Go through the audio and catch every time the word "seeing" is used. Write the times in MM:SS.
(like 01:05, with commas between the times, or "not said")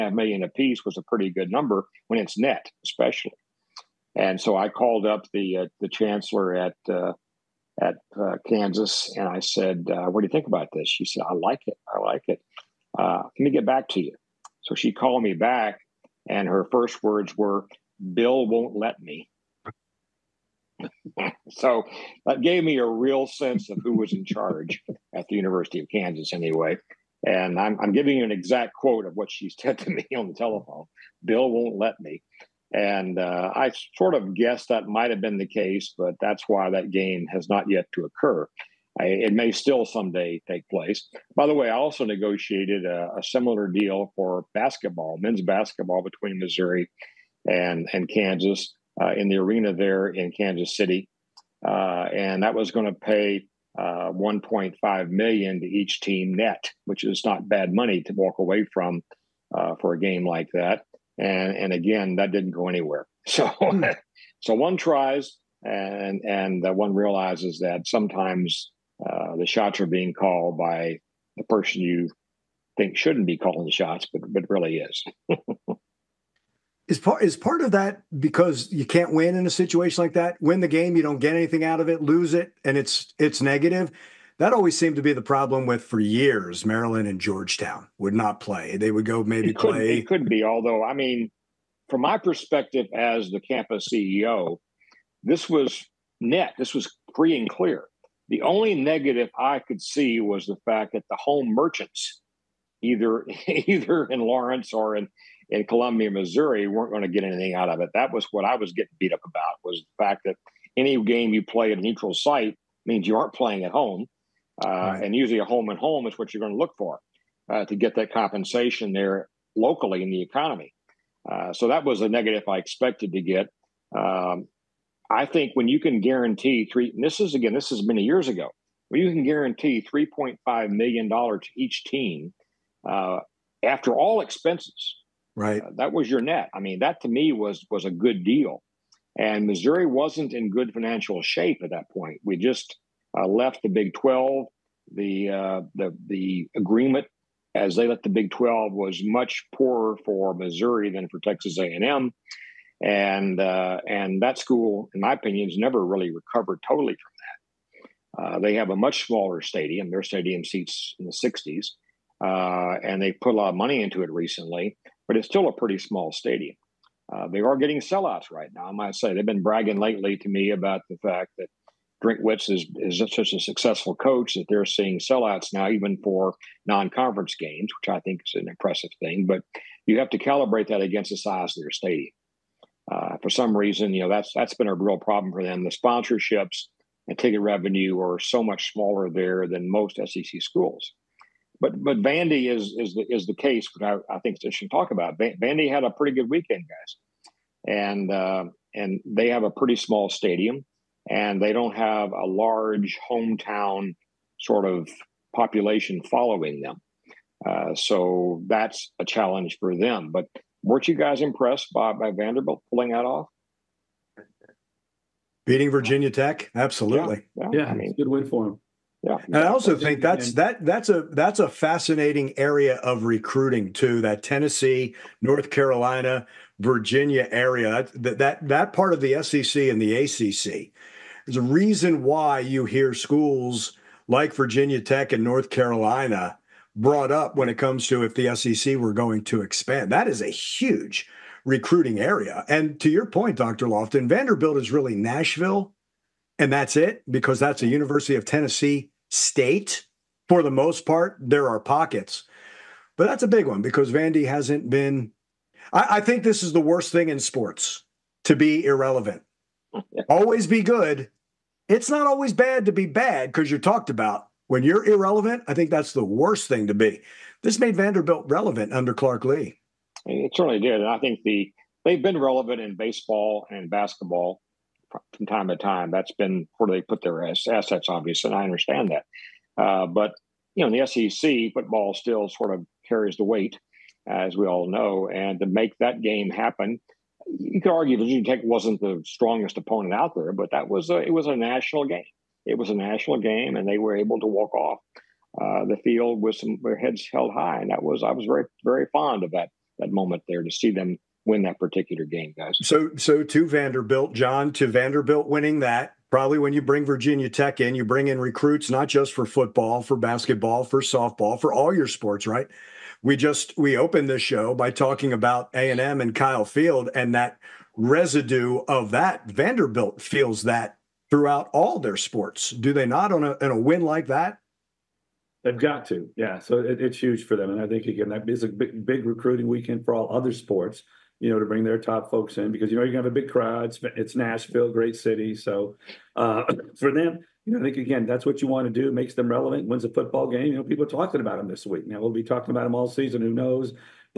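02:54.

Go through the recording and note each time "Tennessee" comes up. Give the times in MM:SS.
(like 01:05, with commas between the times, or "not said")
03:44, 04:08.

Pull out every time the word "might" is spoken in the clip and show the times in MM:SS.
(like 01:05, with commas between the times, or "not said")
00:34, 02:48.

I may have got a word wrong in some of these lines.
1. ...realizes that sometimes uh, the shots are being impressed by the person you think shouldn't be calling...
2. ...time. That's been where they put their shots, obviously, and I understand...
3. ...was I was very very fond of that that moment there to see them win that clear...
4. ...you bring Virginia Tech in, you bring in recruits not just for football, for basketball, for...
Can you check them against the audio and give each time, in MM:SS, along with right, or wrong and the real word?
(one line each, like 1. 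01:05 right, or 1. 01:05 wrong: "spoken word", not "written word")
1. 01:06 wrong: "called", not "impressed"
2. 04:35 wrong: "assets", not "shots"
3. 04:57 wrong: "particular", not "clear"
4. 05:06 right.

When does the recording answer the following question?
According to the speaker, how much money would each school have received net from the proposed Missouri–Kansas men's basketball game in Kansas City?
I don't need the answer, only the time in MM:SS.
00:54.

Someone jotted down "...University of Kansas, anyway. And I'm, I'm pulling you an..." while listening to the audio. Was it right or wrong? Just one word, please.
wrong.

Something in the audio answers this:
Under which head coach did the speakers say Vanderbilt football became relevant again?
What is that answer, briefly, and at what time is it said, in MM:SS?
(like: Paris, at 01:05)
Clark Lea, at 04:28.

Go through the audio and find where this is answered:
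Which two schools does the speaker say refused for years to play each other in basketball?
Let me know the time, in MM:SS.
01:26.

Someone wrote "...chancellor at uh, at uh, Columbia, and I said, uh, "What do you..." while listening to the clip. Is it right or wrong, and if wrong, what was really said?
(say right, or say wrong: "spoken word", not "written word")
wrong: "Kansas", not "Columbia".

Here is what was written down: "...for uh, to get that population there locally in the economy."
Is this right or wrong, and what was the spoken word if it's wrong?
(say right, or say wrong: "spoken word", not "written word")
wrong: "compensation", not "population".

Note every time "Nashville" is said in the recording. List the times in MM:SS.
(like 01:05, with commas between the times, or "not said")
04:04, 05:34.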